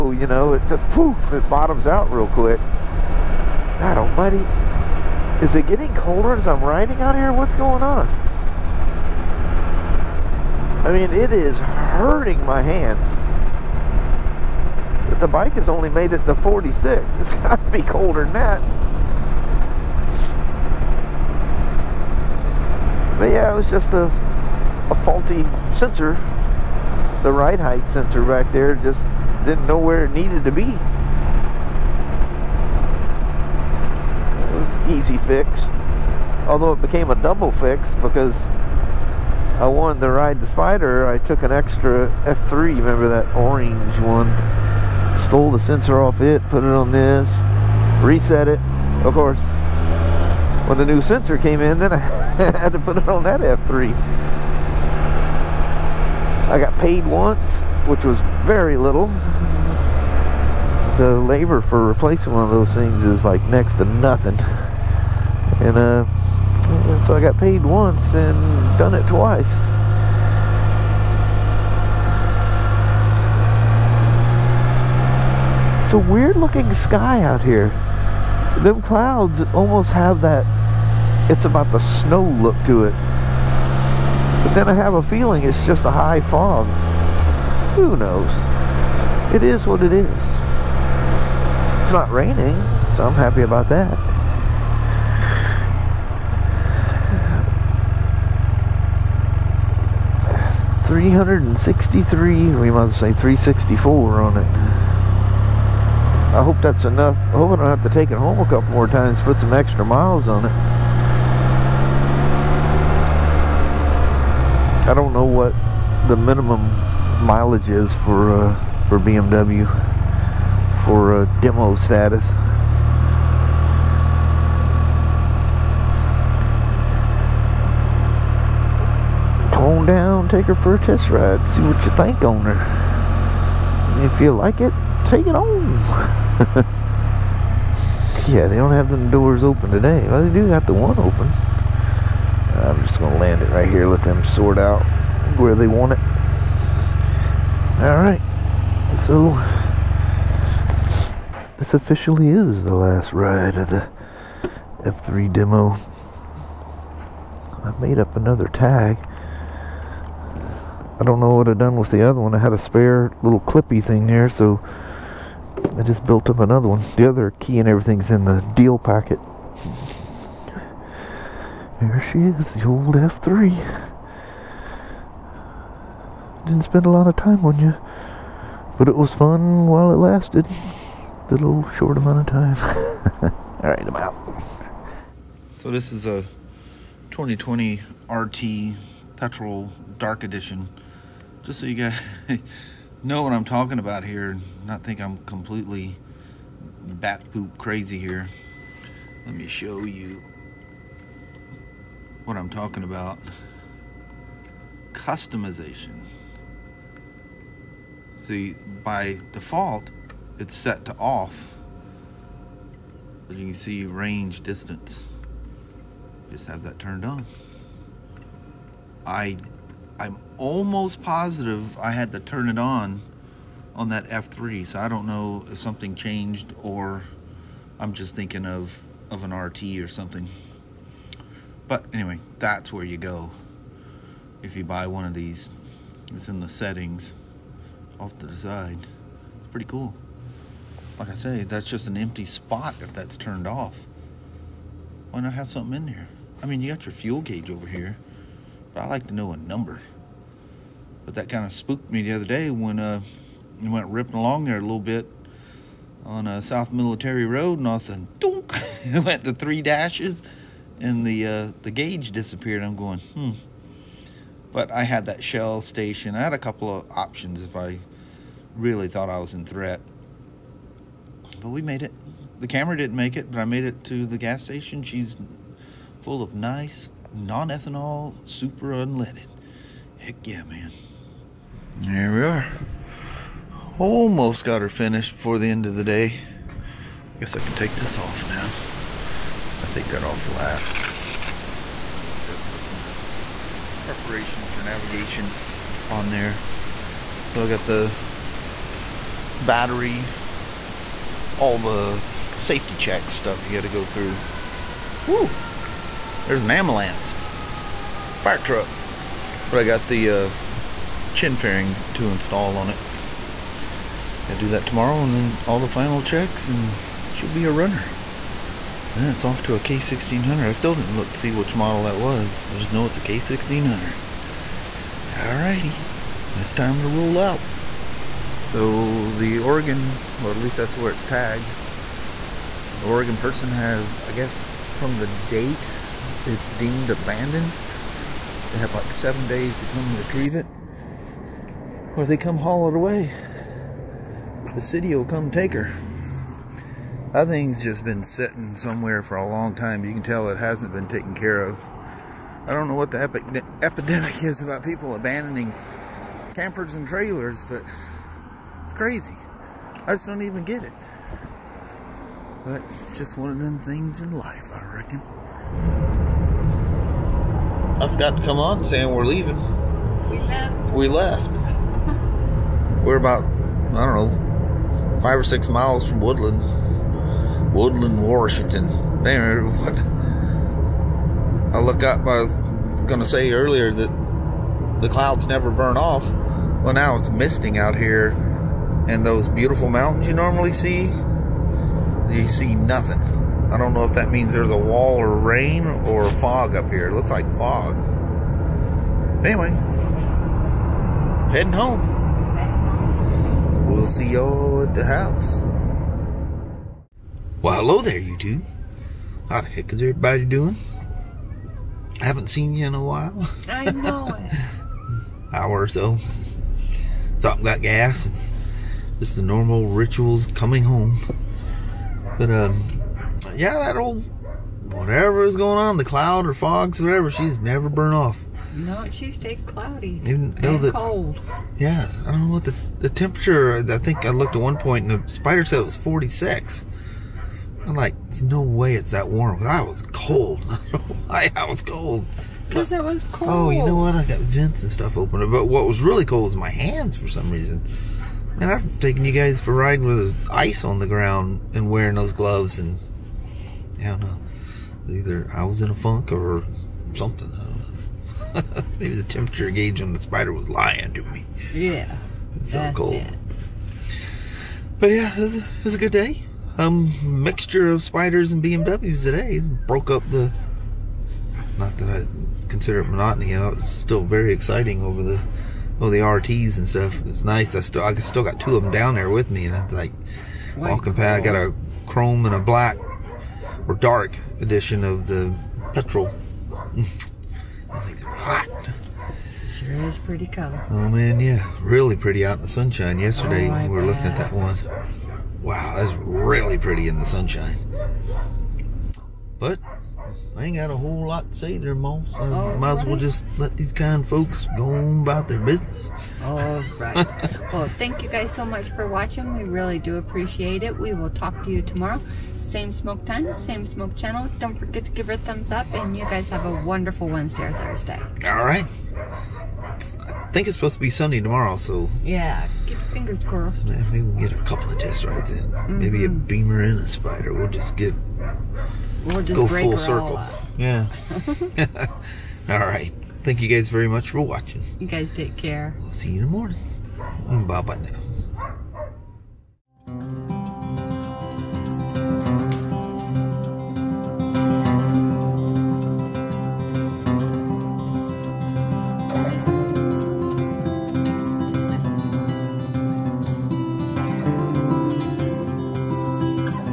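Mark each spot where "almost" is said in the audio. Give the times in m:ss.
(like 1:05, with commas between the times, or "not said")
1:19, 3:40, 4:43.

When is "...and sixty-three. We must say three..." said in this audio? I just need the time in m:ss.
1:41.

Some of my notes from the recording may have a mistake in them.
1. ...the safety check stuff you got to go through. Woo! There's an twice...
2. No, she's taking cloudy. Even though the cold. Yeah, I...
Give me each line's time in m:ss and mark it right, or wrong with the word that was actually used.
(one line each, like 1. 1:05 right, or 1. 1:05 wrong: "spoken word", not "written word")
1. 5:01 wrong: "ambulance", not "twice"
2. 7:08 right.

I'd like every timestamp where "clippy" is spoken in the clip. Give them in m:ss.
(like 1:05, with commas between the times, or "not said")
2:43.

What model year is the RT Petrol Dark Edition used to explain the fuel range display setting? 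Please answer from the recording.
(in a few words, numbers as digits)
2020.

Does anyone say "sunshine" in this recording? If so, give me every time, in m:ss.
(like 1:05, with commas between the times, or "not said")
8:12, 8:17.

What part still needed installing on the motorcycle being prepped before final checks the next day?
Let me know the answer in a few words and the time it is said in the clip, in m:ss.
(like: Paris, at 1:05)
chin fairing, at 5:11.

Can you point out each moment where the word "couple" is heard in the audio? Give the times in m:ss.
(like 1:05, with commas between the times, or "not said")
1:48, 4:26, 8:44.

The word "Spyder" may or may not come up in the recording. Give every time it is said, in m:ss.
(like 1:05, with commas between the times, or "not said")
0:40, 7:15, 7:39, 7:47, 8:46.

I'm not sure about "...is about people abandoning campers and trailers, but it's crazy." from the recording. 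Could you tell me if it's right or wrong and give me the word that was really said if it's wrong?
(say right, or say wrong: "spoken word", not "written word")
right.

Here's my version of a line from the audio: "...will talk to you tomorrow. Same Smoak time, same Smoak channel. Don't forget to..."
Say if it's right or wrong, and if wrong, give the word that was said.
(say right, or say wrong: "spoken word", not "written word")
right.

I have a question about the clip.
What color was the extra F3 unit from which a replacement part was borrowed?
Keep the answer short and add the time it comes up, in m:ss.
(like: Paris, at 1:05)
orange, at 0:43.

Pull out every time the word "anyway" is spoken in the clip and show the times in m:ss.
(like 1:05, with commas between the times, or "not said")
3:51, 6:19, 6:39.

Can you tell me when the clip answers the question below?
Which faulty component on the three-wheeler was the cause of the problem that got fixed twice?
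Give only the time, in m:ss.
0:27.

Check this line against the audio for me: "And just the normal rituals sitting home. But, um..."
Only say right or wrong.
wrong.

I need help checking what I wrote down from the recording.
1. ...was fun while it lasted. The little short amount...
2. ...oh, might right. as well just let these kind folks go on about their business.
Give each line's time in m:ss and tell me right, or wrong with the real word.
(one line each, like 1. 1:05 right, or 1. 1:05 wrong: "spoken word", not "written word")
1. 2:58 right
2. 8:22 right.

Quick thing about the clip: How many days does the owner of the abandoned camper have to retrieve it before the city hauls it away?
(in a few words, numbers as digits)
7.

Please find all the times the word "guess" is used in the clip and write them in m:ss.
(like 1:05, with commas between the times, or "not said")
4:47, 5:34.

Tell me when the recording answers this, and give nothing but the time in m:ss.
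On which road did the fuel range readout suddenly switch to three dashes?
4:16.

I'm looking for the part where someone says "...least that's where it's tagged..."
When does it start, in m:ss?
5:30.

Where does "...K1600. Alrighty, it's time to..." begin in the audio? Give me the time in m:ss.
5:23.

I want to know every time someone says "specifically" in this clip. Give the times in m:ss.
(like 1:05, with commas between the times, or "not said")
not said.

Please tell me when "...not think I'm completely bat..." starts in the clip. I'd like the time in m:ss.
3:14.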